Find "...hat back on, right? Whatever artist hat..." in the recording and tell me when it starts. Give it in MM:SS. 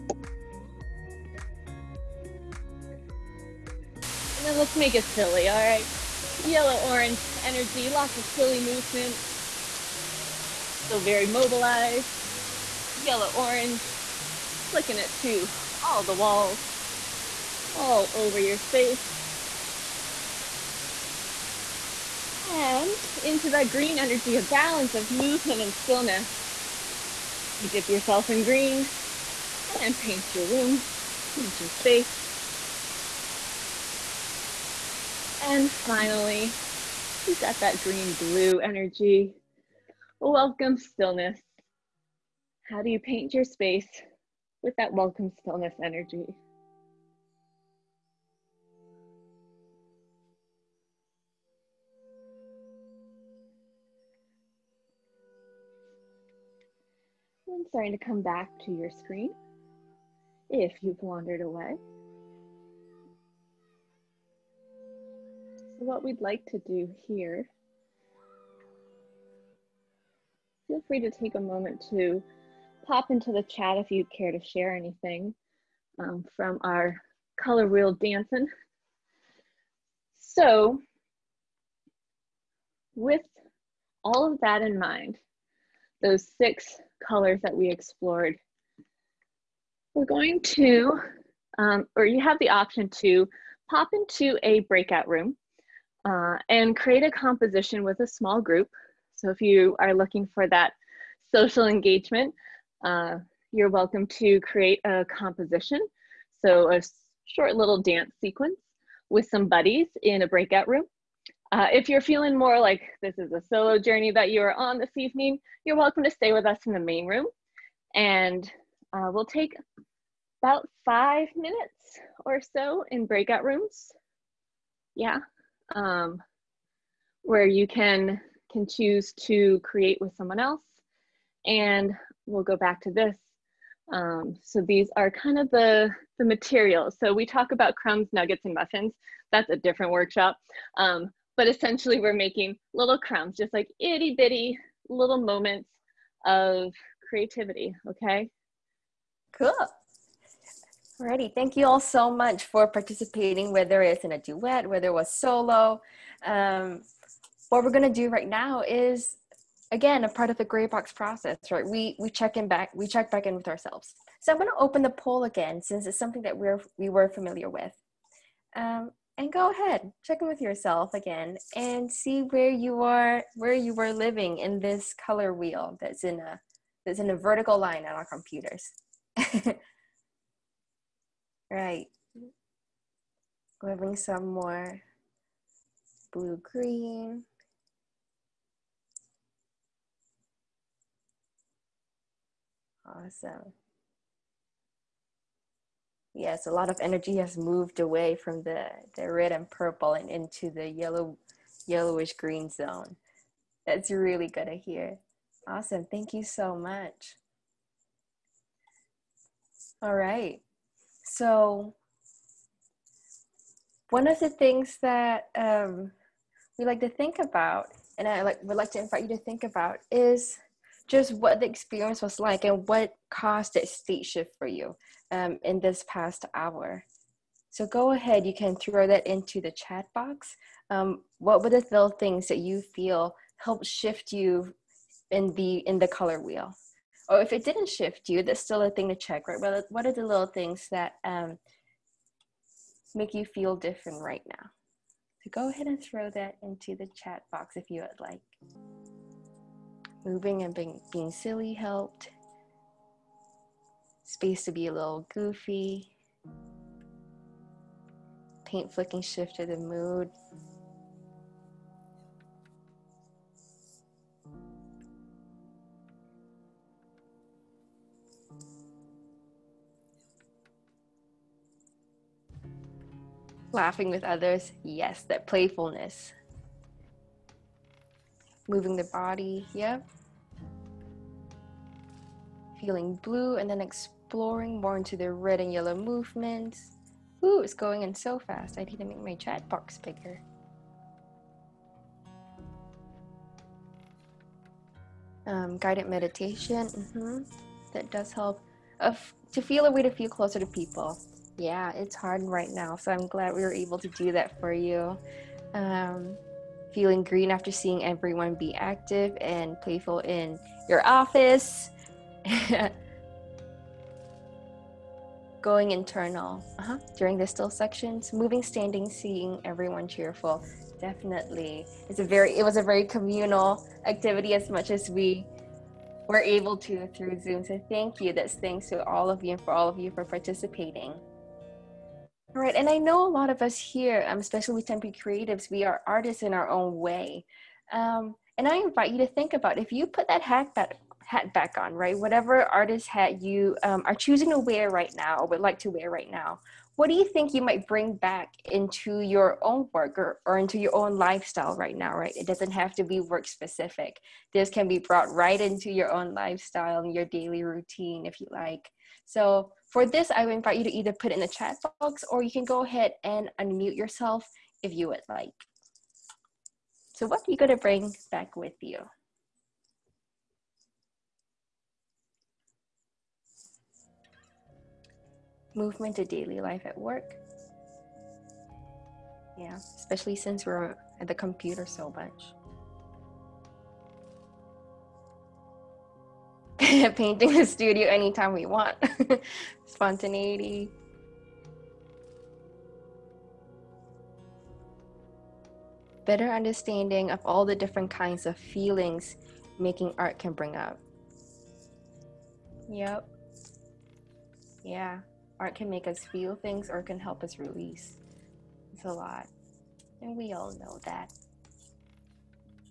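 05:41.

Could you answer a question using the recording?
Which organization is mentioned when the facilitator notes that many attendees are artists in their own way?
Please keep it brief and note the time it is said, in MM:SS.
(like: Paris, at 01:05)
Tempe Creatives, at 05:34.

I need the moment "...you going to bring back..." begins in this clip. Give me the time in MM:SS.
06:07.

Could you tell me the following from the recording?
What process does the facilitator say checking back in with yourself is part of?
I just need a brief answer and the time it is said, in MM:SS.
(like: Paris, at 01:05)
Grey Box process, at 02:40.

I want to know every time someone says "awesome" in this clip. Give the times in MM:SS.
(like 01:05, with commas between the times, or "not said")
03:12, 03:25.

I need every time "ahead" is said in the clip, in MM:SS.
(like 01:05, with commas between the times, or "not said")
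02:49, 03:47, 04:05, 06:02.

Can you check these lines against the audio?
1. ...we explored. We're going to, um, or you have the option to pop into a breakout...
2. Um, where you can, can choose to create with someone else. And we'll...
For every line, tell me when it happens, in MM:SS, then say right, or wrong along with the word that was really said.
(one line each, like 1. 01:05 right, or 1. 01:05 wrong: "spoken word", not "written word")
1. 01:27 right
2. 02:05 right.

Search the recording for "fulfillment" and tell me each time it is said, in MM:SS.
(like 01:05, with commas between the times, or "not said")
not said.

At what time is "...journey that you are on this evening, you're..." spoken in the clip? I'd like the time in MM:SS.
01:53.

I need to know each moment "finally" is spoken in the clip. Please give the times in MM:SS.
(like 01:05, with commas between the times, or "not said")
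00:35.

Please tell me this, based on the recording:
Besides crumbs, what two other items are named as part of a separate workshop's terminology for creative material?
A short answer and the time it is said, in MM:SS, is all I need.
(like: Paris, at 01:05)
Nuggets and muffins, at 02:18.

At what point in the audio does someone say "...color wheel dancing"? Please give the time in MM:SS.
01:17.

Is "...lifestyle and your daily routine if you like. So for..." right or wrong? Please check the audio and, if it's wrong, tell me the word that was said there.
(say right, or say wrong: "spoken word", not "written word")
right.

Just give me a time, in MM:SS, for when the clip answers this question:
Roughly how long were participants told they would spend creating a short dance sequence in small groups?
02:00.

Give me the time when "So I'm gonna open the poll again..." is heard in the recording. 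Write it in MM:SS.
02:44.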